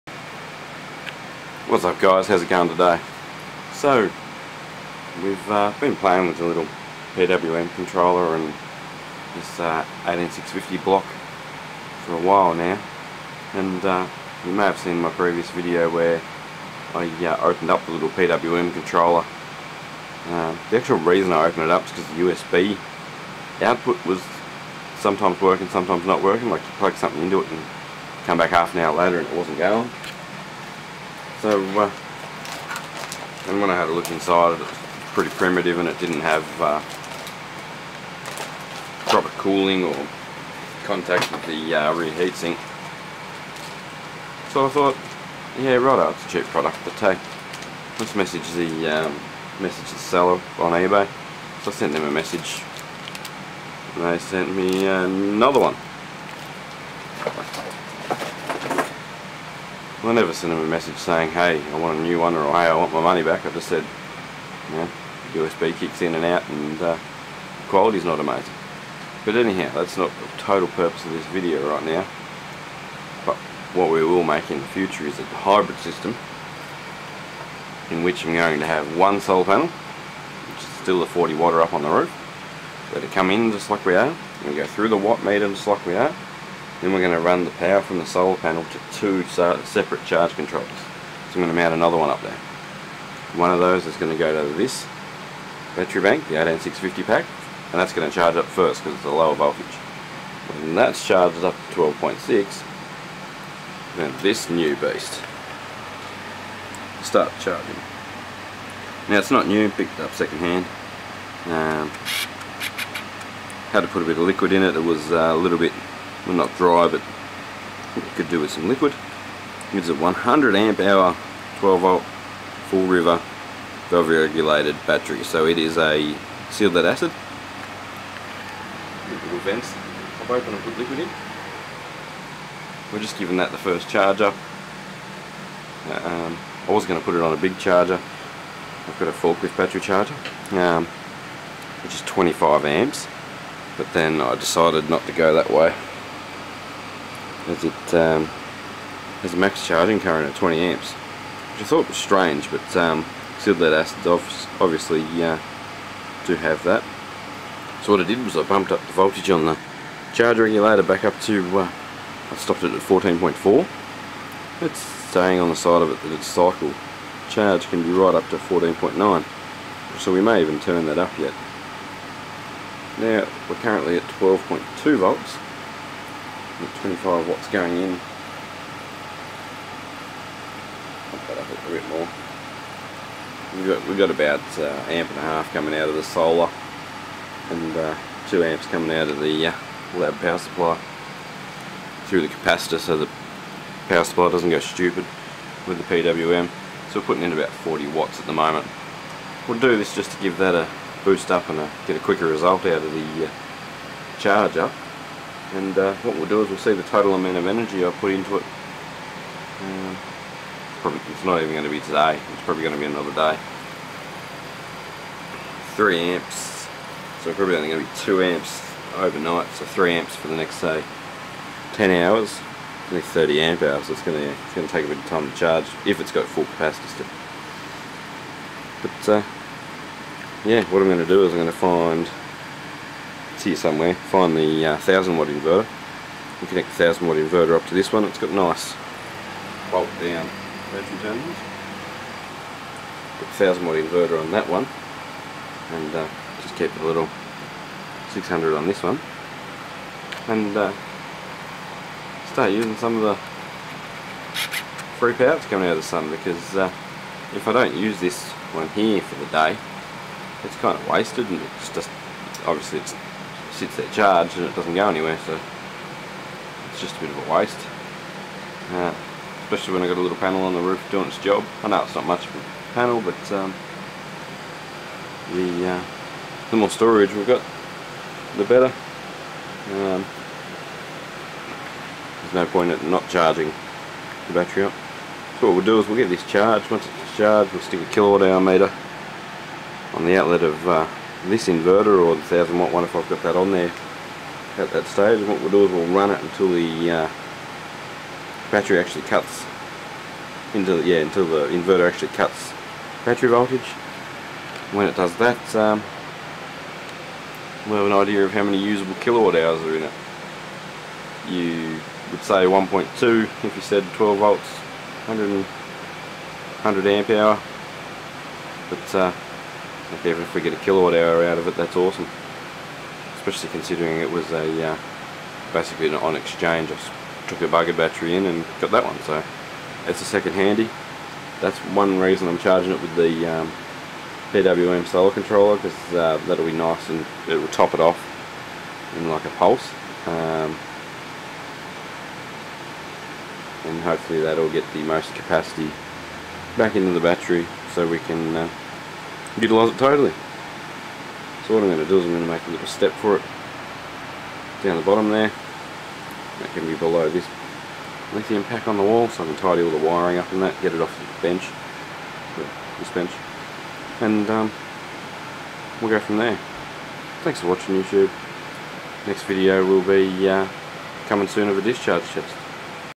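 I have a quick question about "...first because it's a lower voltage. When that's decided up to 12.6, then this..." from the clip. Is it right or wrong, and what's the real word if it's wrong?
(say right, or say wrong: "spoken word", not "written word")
wrong: "charged", not "decided".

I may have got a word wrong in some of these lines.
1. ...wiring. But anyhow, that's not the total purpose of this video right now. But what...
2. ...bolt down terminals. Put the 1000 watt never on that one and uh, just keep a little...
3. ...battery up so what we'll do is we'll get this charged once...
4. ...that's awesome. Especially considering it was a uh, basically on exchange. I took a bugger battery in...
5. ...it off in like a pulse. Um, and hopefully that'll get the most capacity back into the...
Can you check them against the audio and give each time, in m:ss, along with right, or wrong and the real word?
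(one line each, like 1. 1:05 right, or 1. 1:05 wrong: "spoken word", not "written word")
1. 1:08 wrong: "amazing", not "wiring"
2. 3:59 wrong: "inverter", not "never"
3. 4:44 right
4. 5:21 right
5. 5:37 right.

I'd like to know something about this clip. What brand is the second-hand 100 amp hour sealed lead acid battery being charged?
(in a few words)
Full River.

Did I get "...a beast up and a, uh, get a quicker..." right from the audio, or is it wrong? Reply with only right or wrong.
wrong.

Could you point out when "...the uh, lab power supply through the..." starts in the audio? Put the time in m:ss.
3:09.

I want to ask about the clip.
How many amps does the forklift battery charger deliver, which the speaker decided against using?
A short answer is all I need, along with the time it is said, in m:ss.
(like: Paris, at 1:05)
25 amps, at 2:22.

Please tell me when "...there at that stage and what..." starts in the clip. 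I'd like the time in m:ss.
4:53.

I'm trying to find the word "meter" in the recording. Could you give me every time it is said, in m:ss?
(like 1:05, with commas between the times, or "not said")
1:25, 4:48.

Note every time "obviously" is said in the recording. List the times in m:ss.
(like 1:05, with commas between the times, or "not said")
2:34, 4:22.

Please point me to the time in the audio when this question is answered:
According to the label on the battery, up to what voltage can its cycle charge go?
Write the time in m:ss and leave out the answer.
2:48.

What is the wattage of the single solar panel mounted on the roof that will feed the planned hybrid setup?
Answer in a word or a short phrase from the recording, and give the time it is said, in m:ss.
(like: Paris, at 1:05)
40 watt, at 1:21.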